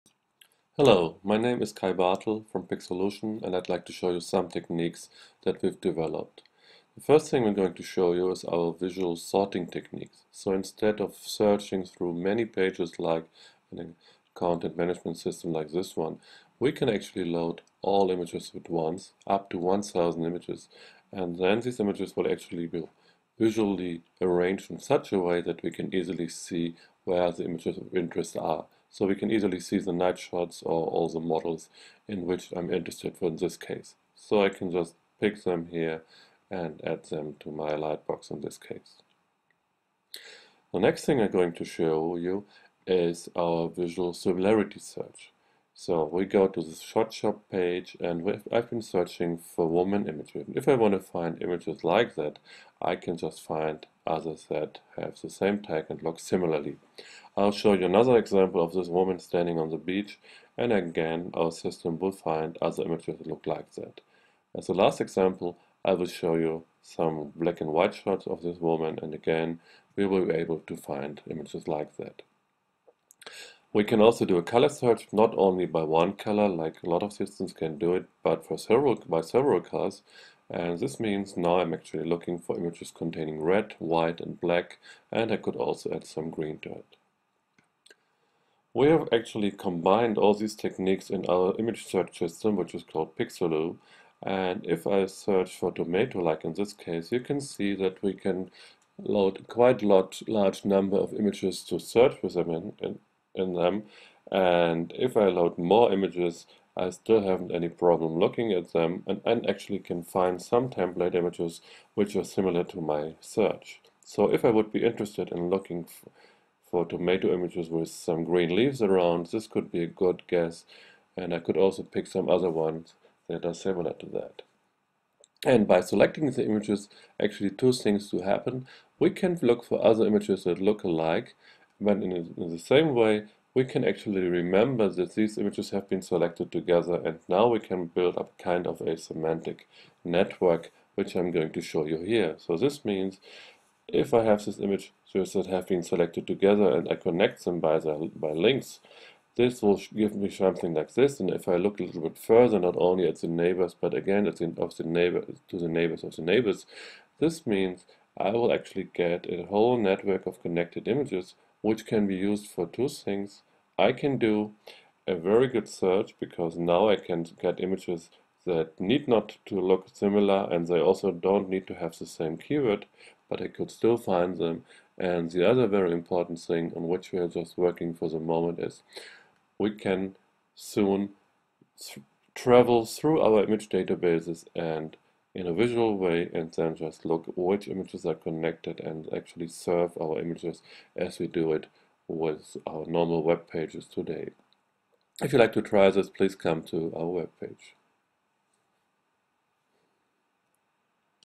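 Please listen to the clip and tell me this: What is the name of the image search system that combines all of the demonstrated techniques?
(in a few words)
Pixolu.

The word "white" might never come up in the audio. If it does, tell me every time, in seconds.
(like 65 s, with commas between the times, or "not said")
67 s, 83 s.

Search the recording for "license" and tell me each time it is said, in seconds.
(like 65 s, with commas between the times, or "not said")
not said.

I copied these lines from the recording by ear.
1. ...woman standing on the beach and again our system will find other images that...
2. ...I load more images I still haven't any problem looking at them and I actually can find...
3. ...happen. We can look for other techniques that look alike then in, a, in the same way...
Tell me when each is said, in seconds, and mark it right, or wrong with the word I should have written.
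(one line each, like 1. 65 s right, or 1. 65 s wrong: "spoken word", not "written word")
1. 58 s right
2. 105 s right
3. 128 s wrong: "images", not "techniques".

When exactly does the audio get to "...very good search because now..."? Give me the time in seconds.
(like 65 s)
165 s.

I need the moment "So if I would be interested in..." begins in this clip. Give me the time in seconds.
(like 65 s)
114 s.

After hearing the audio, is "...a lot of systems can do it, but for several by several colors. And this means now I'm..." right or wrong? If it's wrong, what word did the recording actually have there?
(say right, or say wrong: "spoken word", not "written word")
right.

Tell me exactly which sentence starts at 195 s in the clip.
If you'd like to try this, please come to our web page.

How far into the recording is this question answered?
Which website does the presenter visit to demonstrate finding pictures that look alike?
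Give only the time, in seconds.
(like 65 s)
46 s.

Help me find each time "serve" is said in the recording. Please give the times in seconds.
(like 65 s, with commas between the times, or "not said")
189 s.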